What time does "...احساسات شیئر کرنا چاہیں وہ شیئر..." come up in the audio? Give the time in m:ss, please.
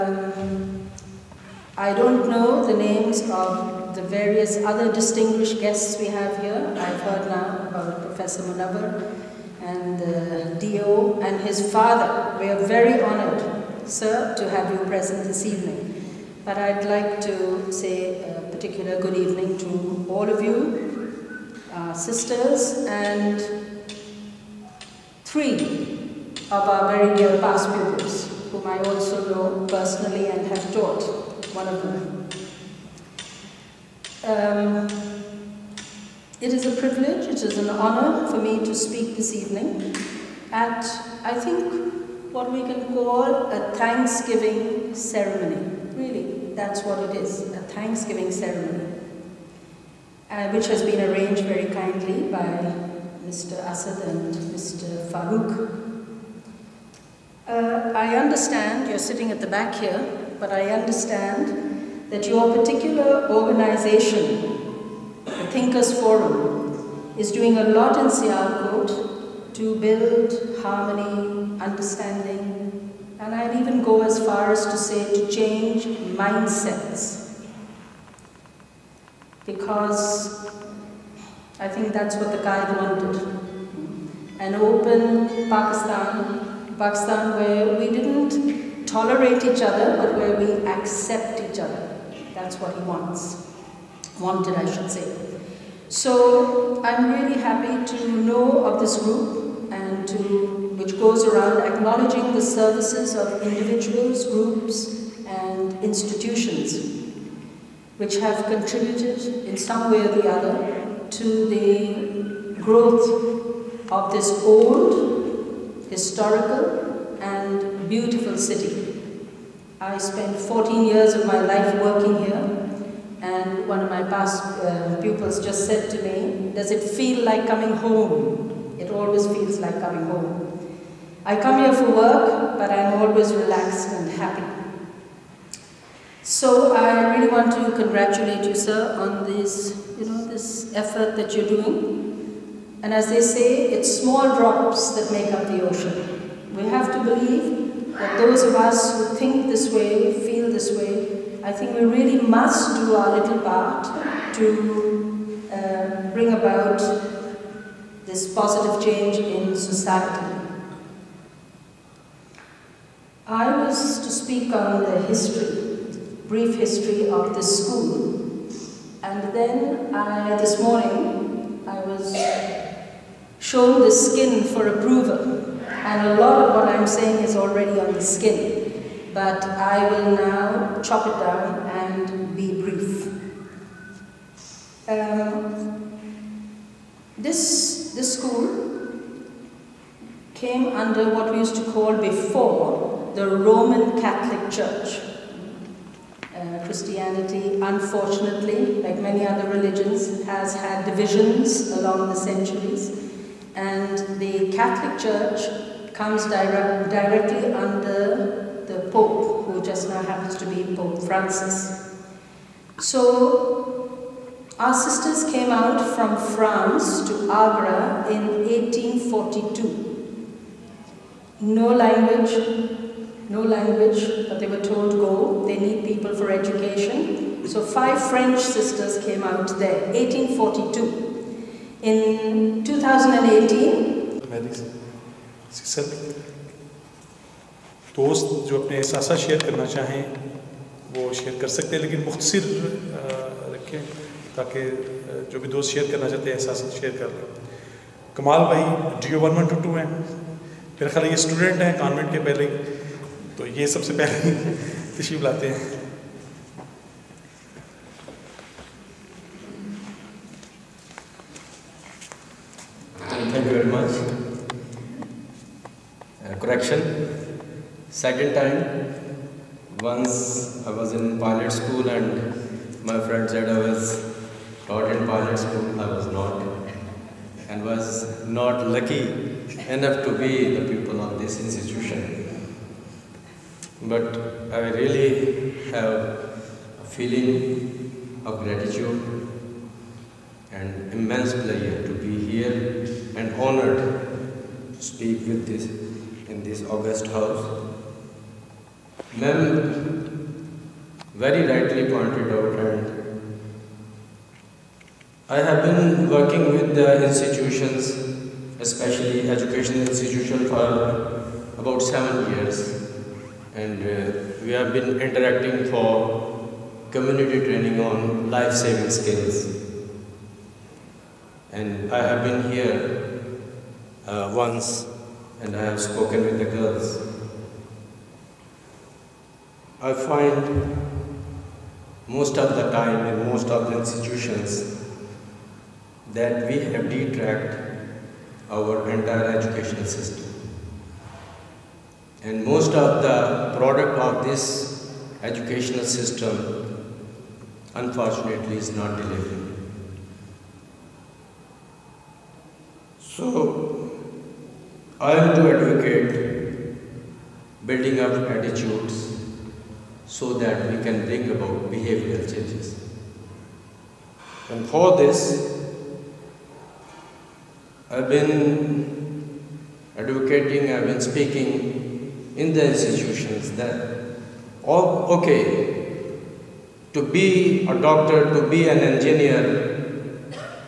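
3:58.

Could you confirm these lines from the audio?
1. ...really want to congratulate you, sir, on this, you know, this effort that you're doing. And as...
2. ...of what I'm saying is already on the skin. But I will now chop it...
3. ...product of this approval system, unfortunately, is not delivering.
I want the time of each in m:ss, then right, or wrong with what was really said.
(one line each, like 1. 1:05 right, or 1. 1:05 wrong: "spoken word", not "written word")
1. 2:17 right
2. 2:56 right
3. 5:43 wrong: "educational", not "approval".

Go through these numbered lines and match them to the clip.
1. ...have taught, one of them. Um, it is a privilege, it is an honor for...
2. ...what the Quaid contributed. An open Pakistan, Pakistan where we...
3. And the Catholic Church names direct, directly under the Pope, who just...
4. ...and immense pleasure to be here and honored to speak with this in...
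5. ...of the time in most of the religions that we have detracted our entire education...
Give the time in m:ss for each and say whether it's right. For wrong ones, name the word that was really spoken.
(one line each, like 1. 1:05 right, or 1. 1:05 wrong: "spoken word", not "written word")
1. 0:30 right
2. 1:22 wrong: "wanted", not "contributed"
3. 3:23 wrong: "comes", not "names"
4. 4:50 right
5. 5:32 wrong: "institutions", not "religions".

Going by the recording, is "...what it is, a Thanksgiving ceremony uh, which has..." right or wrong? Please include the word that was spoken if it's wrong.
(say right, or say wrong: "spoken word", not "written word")
right.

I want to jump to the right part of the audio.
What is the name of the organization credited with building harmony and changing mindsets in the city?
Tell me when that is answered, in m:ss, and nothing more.
1:05.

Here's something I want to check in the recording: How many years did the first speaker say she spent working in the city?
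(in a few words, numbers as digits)
14.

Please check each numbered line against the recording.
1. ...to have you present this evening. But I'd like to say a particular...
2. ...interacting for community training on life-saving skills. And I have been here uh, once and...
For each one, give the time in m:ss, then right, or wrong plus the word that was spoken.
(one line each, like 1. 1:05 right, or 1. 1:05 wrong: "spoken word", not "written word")
1. 0:14 right
2. 5:15 right.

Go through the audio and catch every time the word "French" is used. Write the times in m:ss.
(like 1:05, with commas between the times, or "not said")
3:48.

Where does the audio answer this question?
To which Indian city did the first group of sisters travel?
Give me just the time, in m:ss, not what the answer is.
3:37.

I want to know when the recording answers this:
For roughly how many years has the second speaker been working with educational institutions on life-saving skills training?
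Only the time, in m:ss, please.
5:11.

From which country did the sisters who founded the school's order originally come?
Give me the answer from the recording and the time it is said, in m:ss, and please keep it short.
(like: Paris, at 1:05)
France, at 3:36.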